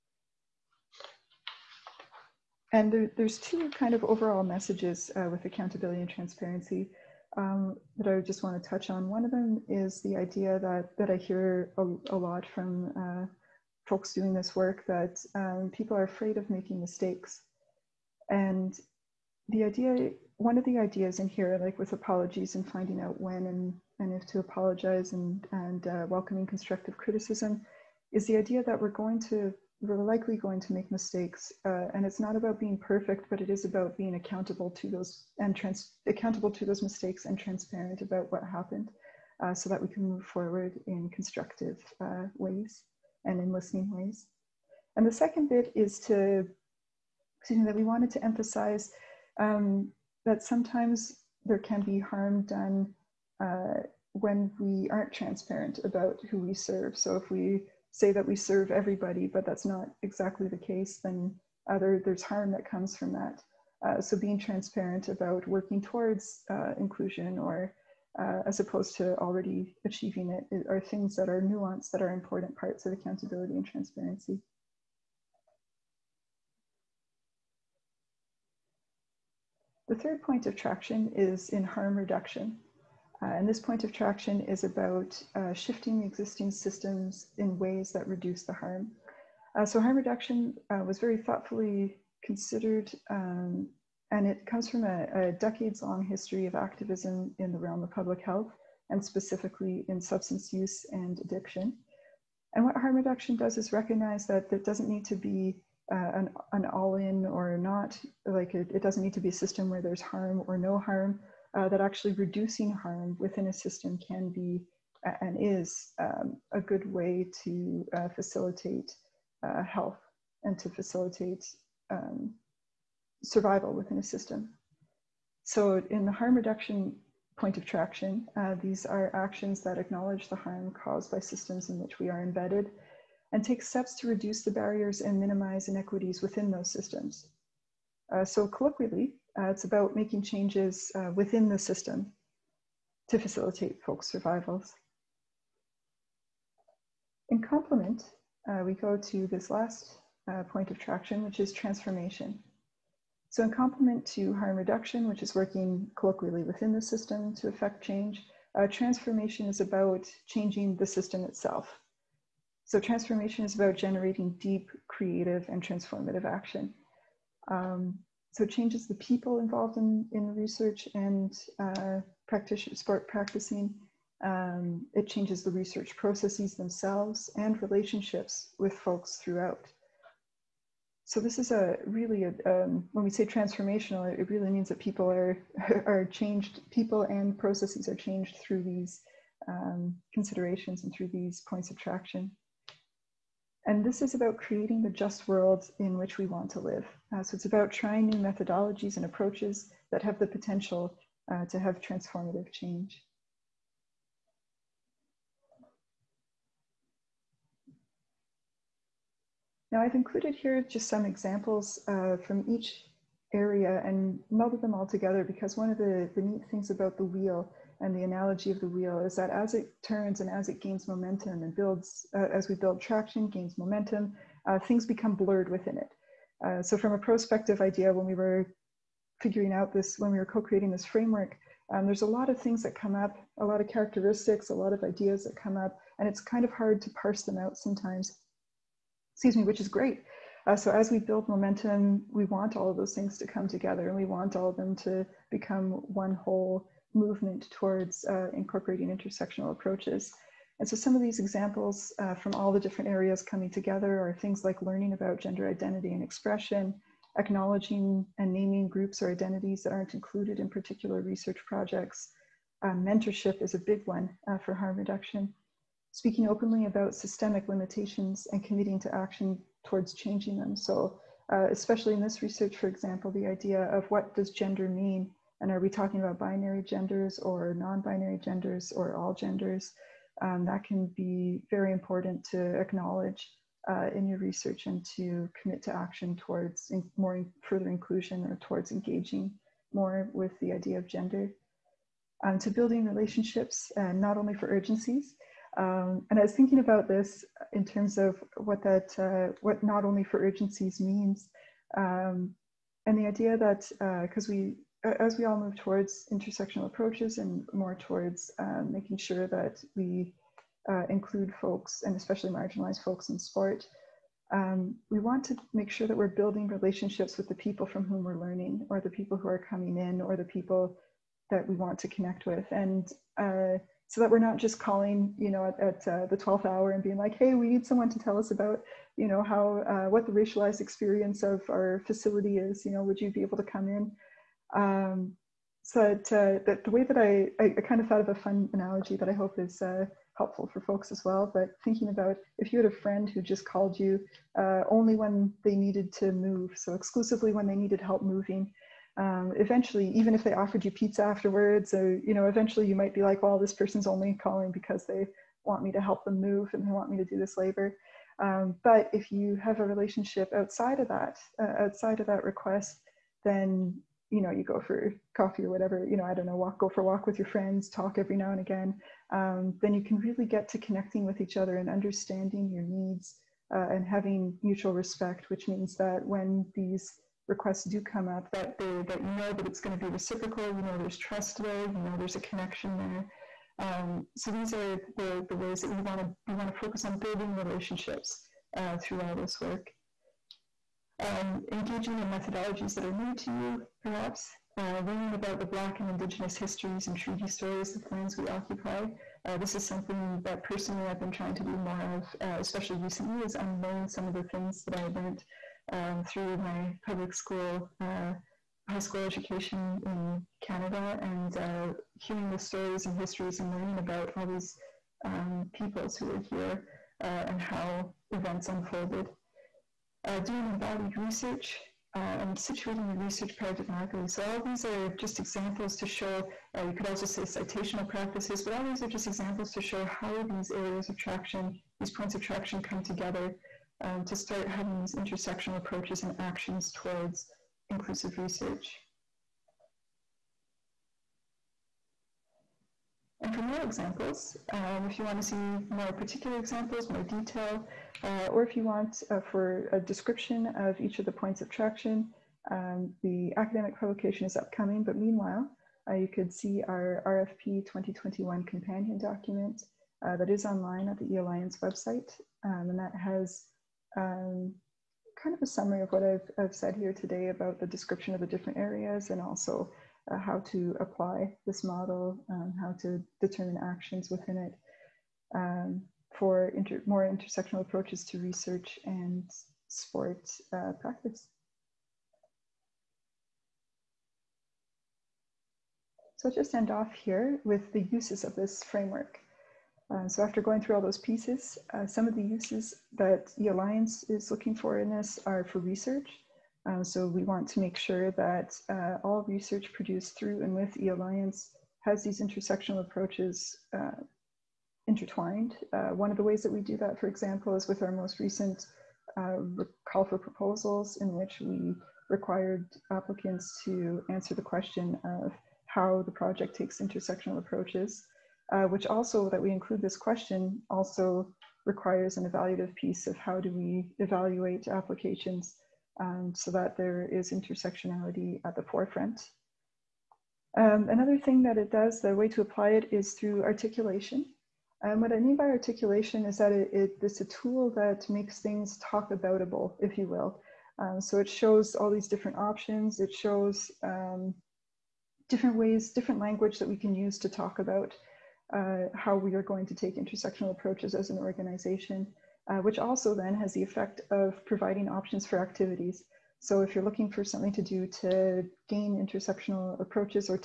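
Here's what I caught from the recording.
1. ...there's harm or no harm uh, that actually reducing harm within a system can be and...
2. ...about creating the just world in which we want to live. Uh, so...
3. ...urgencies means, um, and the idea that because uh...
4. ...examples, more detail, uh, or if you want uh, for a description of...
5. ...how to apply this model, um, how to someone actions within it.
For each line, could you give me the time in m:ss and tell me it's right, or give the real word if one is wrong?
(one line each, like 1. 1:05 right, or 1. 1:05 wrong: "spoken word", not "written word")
1. 1:49 right
2. 3:14 right
3. 5:00 right
4. 7:26 right
5. 7:50 wrong: "determine", not "someone".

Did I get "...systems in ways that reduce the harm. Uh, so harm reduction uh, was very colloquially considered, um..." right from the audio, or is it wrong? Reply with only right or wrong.
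wrong.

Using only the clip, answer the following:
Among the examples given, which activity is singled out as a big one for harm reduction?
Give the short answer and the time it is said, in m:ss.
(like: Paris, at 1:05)
Mentorship, at 4:22.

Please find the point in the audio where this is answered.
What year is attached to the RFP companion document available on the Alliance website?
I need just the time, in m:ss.
7:37.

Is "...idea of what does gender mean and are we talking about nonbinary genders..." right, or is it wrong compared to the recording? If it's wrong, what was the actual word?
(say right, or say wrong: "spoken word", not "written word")
wrong: "binary", not "nonbinary".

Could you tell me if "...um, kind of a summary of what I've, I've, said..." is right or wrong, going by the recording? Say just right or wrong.
right.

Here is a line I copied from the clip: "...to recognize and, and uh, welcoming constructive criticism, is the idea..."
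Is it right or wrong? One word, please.
wrong.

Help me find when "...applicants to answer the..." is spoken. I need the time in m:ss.
8:32.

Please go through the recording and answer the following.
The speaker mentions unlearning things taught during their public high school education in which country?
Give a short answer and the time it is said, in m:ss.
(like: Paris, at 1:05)
Canada, at 6:50.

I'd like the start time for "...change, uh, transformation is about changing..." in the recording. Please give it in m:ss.
2:37.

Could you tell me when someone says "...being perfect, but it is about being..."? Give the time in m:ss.
0:32.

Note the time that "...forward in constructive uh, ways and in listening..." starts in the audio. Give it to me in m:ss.
0:40.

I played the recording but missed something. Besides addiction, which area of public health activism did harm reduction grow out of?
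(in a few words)
Substance use.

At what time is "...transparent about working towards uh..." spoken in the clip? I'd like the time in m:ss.
1:04.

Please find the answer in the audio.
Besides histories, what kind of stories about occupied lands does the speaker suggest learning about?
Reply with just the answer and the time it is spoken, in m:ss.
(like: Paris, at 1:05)
Treaty stories, at 6:36.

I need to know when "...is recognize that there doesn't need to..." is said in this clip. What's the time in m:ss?
1:43.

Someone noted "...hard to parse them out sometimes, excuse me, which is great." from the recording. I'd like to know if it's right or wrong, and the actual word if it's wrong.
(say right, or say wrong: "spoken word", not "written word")
right.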